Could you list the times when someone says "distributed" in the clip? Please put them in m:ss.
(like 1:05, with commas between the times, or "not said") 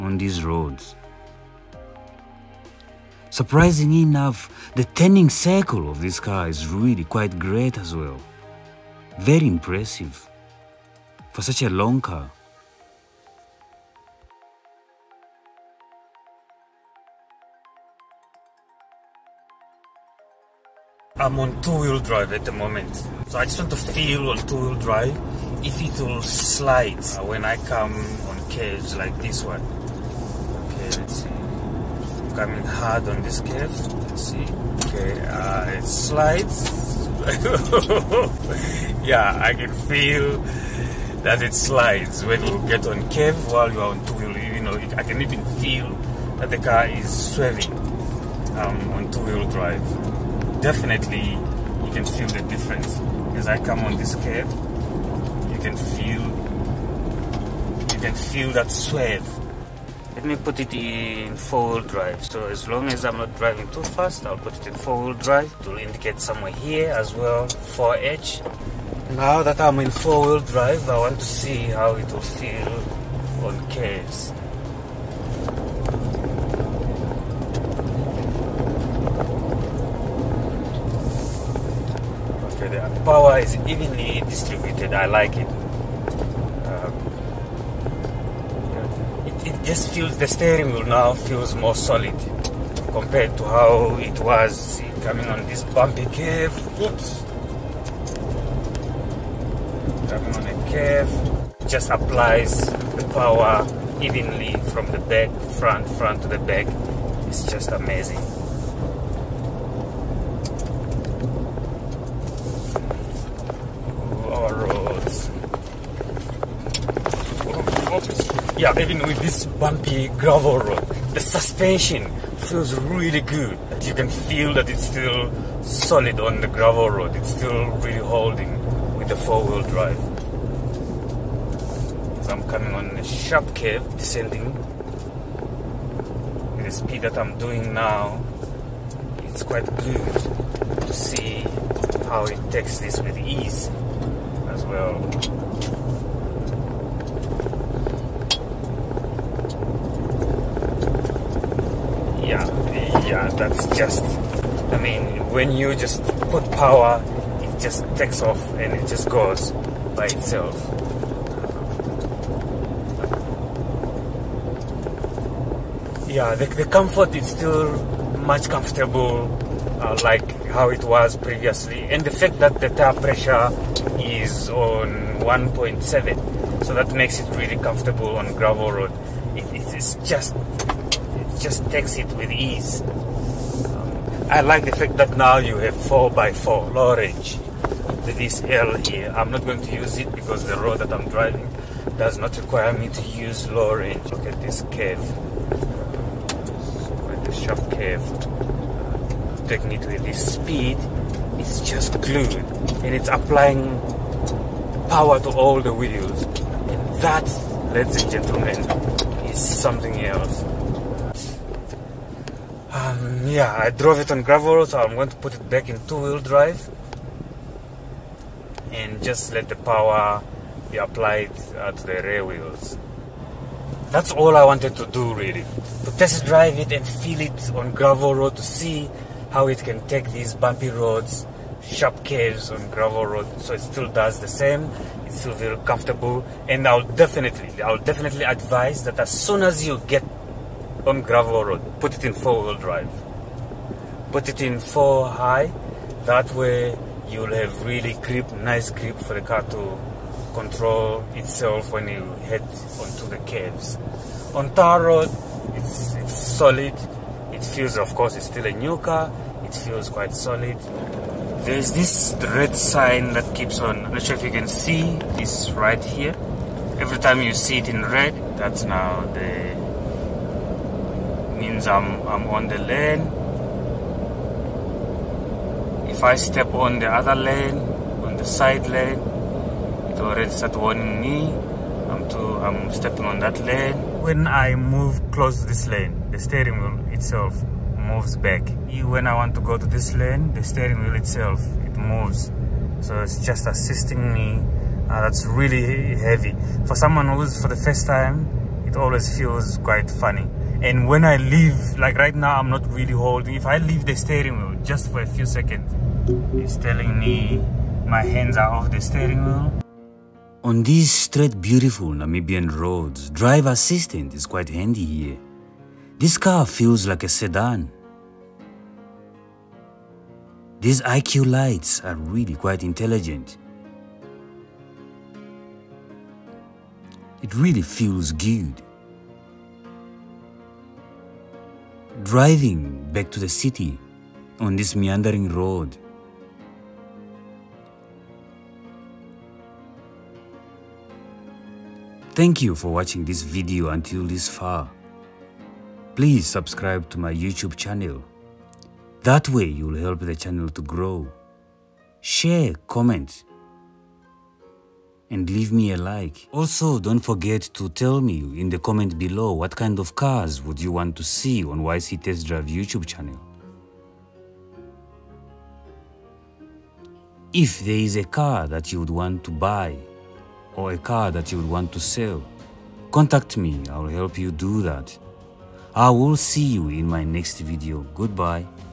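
1:24.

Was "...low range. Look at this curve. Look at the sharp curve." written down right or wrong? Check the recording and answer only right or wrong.
right.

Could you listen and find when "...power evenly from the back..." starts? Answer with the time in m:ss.
1:43.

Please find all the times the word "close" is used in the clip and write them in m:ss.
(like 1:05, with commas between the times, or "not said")
4:45.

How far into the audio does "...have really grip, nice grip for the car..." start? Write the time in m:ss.
4:07.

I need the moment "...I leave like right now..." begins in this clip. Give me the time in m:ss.
5:01.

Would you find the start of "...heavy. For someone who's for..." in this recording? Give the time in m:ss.
4:55.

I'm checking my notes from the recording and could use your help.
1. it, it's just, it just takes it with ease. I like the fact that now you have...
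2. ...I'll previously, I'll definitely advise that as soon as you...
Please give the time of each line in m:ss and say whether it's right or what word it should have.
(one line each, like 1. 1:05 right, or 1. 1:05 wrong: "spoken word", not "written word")
1. 2:59 right
2. 3:56 wrong: "definitely", not "previously".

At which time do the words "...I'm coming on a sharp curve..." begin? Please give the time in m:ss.
2:12.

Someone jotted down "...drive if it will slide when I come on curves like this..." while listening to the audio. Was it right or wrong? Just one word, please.
right.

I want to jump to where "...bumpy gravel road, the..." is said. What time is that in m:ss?
1:59.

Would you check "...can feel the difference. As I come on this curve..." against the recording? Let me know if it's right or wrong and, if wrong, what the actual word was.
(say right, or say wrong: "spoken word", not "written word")
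right.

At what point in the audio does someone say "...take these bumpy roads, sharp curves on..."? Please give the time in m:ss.
3:49.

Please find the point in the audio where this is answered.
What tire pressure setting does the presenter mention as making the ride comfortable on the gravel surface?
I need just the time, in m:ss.
2:55.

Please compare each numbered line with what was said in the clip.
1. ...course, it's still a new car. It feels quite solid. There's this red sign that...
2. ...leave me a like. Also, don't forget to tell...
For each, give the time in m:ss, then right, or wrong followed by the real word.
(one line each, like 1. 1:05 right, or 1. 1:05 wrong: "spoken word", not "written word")
1. 4:17 right
2. 5:55 right.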